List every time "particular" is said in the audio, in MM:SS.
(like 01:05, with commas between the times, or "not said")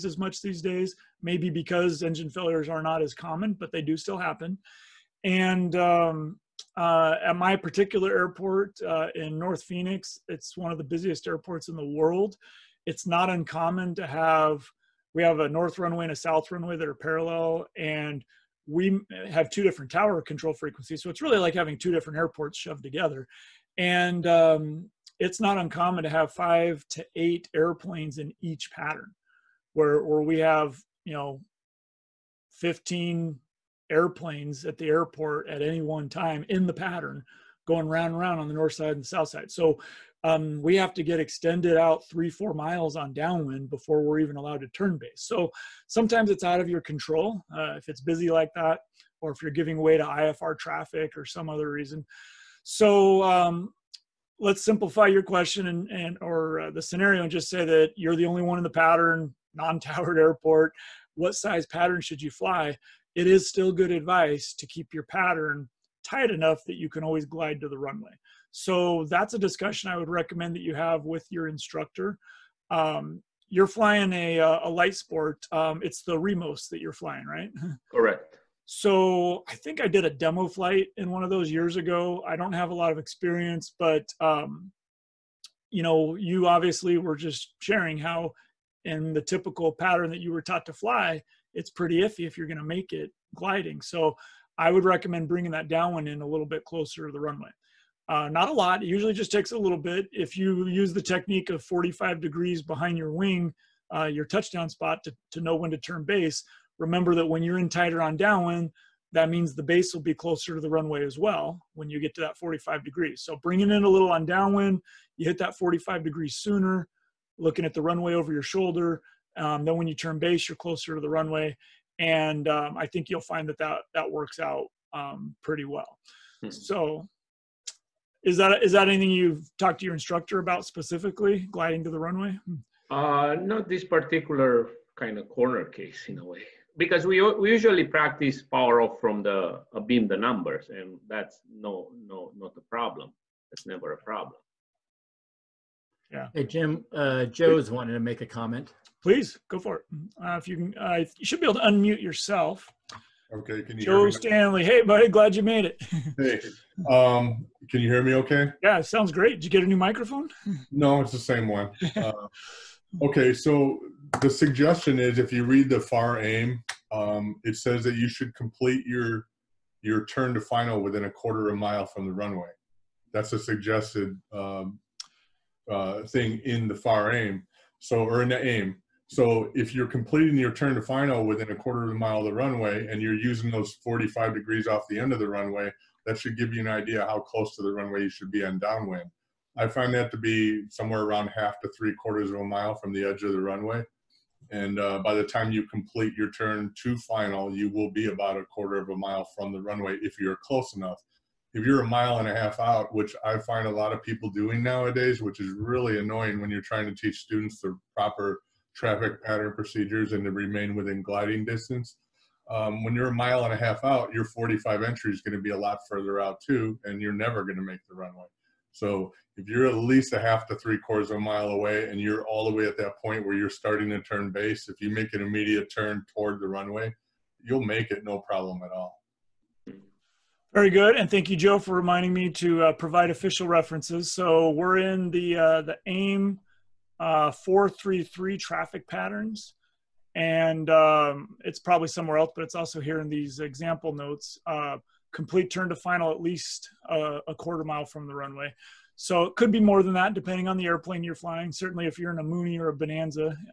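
00:07, 02:13.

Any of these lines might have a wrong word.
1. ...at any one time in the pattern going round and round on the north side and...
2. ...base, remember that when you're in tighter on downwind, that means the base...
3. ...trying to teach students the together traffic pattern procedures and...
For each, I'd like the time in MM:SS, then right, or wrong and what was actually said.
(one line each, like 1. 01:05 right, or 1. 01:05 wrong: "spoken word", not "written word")
1. 00:35 right
2. 01:46 right
3. 03:26 wrong: "proper", not "together".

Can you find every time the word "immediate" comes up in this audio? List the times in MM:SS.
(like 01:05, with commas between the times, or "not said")
03:45.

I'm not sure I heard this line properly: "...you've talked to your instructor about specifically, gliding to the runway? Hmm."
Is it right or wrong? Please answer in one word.
right.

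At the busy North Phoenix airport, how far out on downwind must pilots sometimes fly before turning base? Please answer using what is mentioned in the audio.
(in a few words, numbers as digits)
3-4 miles.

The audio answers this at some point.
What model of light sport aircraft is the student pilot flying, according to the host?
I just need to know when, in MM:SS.
01:16.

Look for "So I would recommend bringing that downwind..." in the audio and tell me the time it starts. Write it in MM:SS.
01:33.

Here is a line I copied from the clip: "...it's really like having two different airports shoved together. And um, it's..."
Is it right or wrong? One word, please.
right.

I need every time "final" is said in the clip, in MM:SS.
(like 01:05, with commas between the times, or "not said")
02:50, 03:00, 03:16, 04:05.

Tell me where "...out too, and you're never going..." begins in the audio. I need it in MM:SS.
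03:36.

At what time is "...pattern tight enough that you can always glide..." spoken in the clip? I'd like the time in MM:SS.
01:05.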